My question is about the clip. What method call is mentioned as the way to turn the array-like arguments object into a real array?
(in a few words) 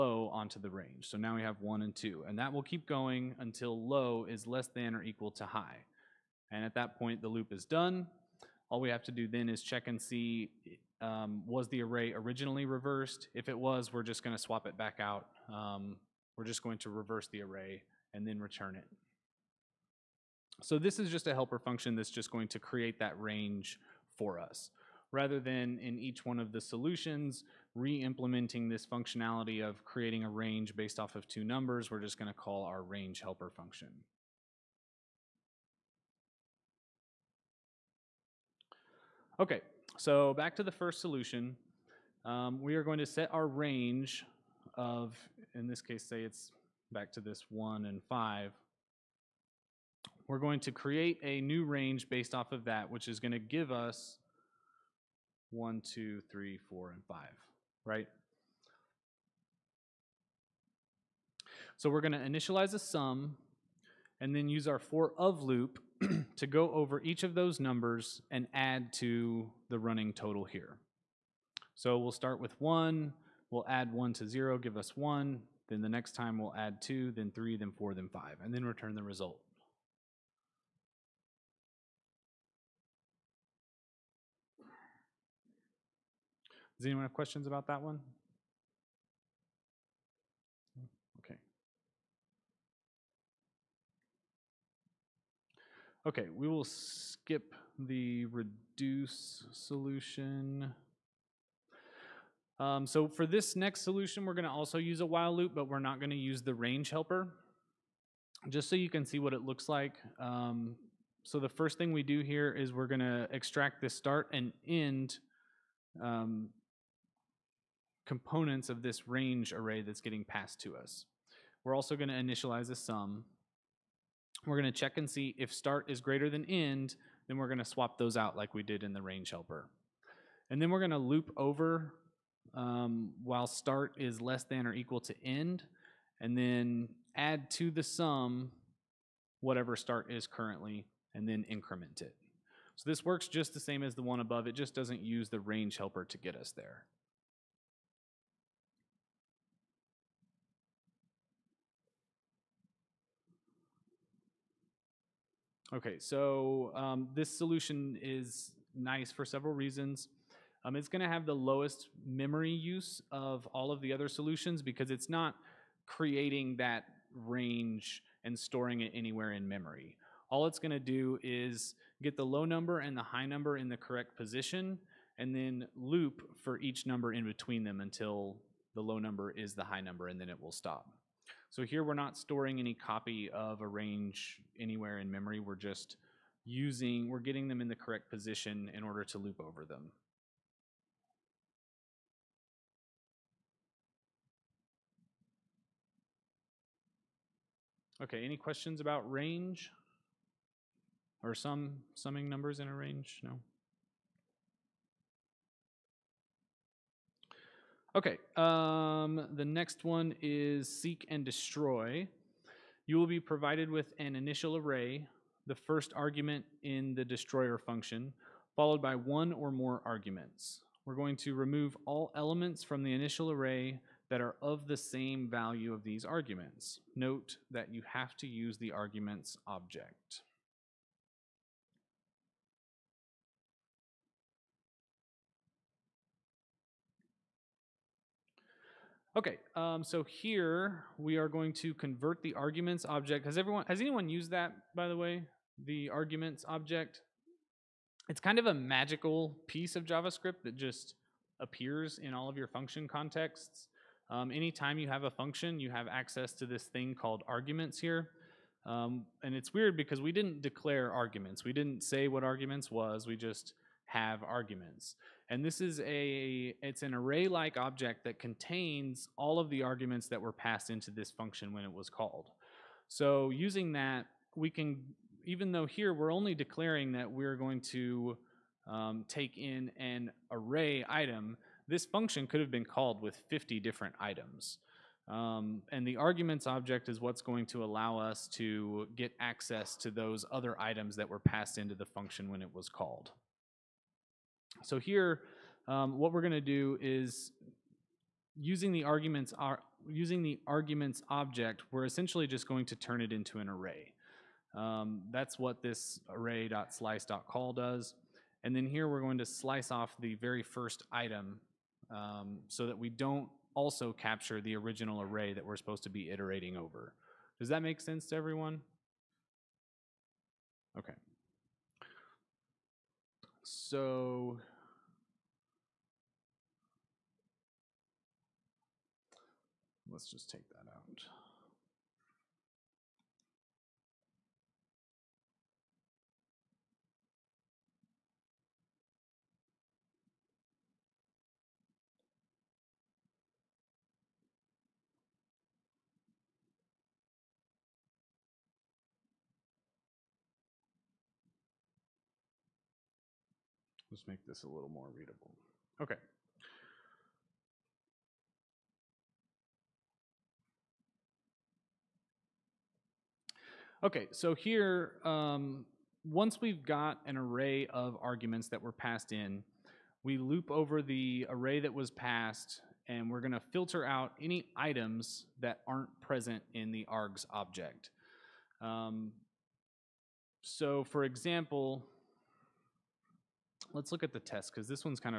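array.slice.call.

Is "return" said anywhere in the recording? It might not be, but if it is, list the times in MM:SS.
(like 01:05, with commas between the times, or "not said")
00:18, 01:18.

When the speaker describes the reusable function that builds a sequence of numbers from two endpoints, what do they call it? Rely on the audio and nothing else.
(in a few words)
range helper function.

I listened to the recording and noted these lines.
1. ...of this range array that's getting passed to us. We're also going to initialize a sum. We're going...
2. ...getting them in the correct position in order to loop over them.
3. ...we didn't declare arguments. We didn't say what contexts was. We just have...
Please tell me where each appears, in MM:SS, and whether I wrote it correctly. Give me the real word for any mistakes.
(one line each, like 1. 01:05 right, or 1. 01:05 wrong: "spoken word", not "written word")
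1. 01:58 right
2. 03:07 right
3. 04:20 wrong: "arguments", not "contexts".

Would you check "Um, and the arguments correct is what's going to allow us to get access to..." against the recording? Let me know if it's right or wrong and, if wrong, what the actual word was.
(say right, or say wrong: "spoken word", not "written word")
wrong: "object", not "correct".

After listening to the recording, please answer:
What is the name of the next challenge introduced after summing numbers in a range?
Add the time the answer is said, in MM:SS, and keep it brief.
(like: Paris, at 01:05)
Seek and Destroy, at 03:30.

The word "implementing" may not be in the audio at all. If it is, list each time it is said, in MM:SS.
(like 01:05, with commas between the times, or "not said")
00:27.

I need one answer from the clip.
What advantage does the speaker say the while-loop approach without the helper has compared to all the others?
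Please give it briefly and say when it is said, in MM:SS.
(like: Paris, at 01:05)
lowest memory use, at 02:41.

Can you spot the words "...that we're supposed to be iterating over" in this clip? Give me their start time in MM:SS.
05:15.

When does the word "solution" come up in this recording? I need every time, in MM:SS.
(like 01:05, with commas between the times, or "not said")
00:26, 00:41, 01:39, 01:43, 02:37, 02:44.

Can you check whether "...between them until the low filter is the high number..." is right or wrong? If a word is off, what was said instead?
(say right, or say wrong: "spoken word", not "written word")
wrong: "number", not "filter".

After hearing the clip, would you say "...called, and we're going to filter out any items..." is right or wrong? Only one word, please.
wrong.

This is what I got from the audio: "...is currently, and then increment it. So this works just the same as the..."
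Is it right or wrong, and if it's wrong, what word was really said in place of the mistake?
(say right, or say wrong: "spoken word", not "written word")
right.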